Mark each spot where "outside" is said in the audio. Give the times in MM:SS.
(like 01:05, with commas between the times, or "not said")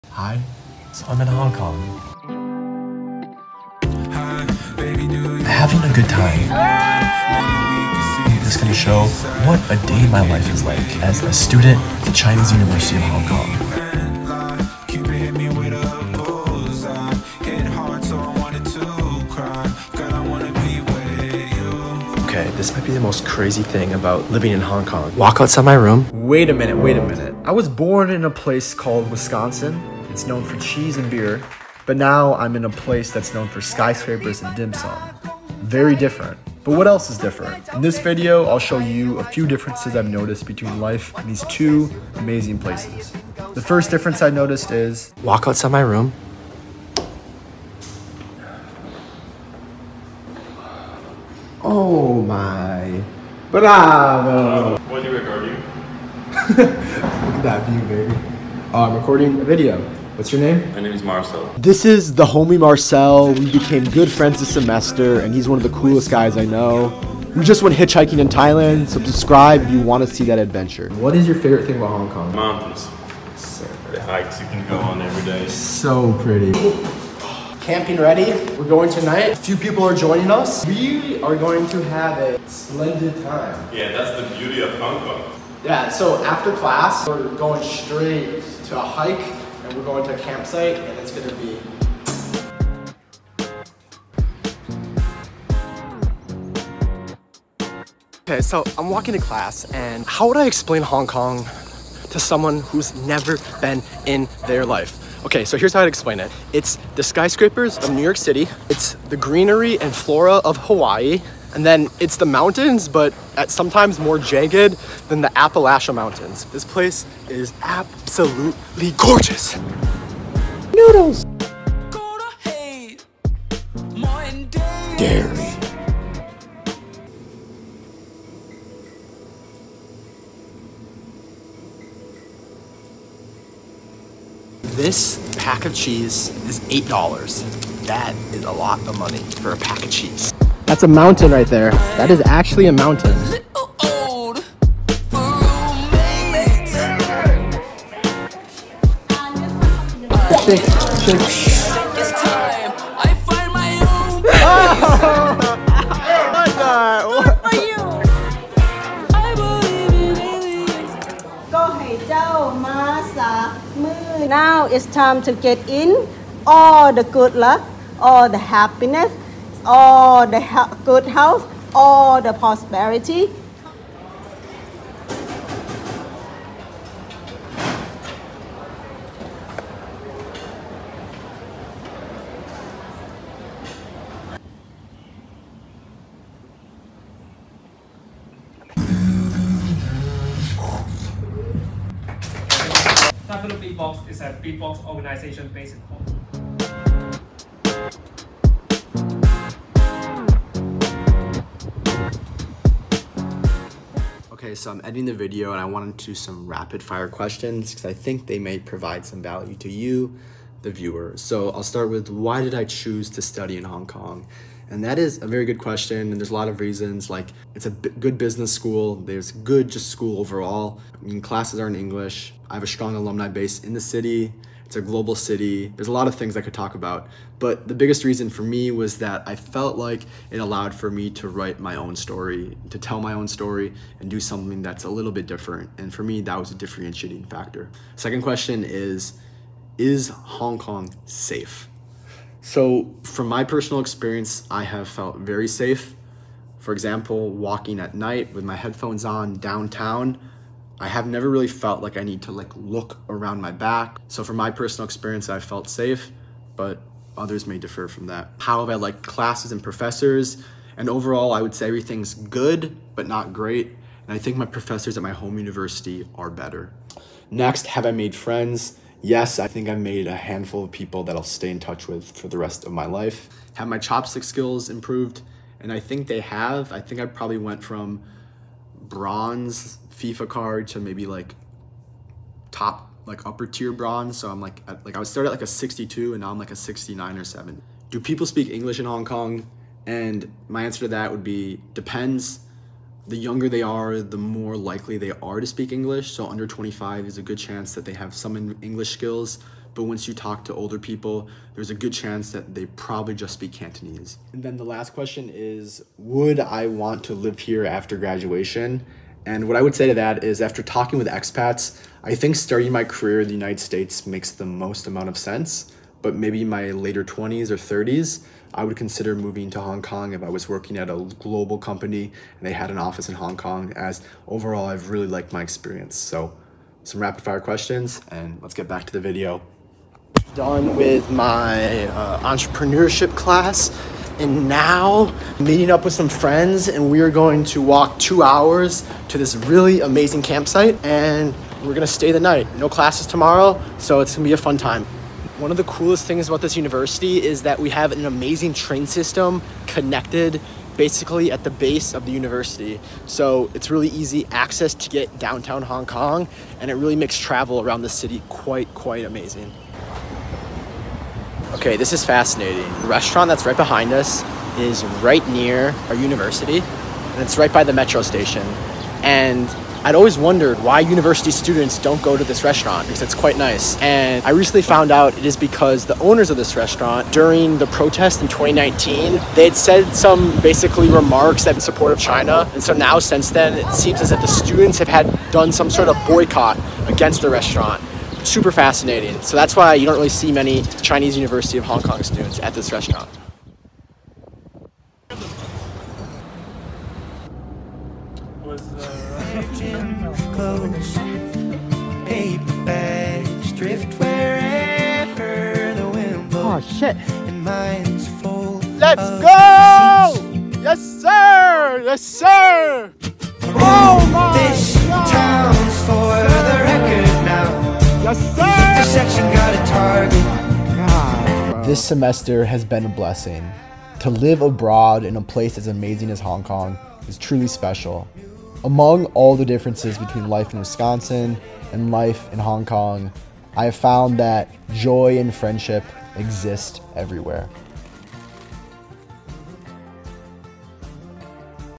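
00:25, 00:45.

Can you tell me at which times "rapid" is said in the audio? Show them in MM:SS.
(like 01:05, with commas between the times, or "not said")
03:26, 05:27.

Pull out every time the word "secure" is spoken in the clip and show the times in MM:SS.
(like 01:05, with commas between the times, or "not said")
not said.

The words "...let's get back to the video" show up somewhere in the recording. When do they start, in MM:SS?
05:28.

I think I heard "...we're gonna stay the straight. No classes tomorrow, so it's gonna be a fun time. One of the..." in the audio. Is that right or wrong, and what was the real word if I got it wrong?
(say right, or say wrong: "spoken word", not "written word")
wrong: "night", not "straight".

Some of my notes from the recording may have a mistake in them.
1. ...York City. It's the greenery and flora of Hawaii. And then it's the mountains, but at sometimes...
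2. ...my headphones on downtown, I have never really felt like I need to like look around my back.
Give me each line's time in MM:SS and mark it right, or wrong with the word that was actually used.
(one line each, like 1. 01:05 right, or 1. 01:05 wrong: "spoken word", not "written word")
1. 01:48 right
2. 04:08 right.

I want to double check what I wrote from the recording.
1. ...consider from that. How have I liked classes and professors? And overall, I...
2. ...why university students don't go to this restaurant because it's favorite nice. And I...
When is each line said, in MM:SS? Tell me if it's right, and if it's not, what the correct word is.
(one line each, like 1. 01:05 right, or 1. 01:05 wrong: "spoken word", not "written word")
1. 04:17 wrong: "differ", not "consider"
2. 06:10 wrong: "quite", not "favorite".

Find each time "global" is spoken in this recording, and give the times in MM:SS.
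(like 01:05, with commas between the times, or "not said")
03:44, 05:21.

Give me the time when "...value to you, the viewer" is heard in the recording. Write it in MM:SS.
03:29.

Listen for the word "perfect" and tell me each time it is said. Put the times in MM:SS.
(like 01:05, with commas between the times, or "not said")
not said.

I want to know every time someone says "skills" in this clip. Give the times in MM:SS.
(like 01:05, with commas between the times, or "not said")
04:34, 04:58.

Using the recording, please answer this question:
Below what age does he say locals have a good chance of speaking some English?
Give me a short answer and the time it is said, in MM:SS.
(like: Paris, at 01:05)
25, at 04:56.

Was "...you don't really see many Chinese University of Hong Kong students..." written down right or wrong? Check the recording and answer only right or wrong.
right.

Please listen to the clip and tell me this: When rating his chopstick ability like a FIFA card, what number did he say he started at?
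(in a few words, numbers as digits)
62.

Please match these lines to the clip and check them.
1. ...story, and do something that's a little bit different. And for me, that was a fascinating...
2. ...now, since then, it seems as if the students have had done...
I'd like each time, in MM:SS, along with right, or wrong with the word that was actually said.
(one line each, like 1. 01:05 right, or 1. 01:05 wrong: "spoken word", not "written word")
1. 03:53 wrong: "differentiating", not "fascinating"
2. 06:22 right.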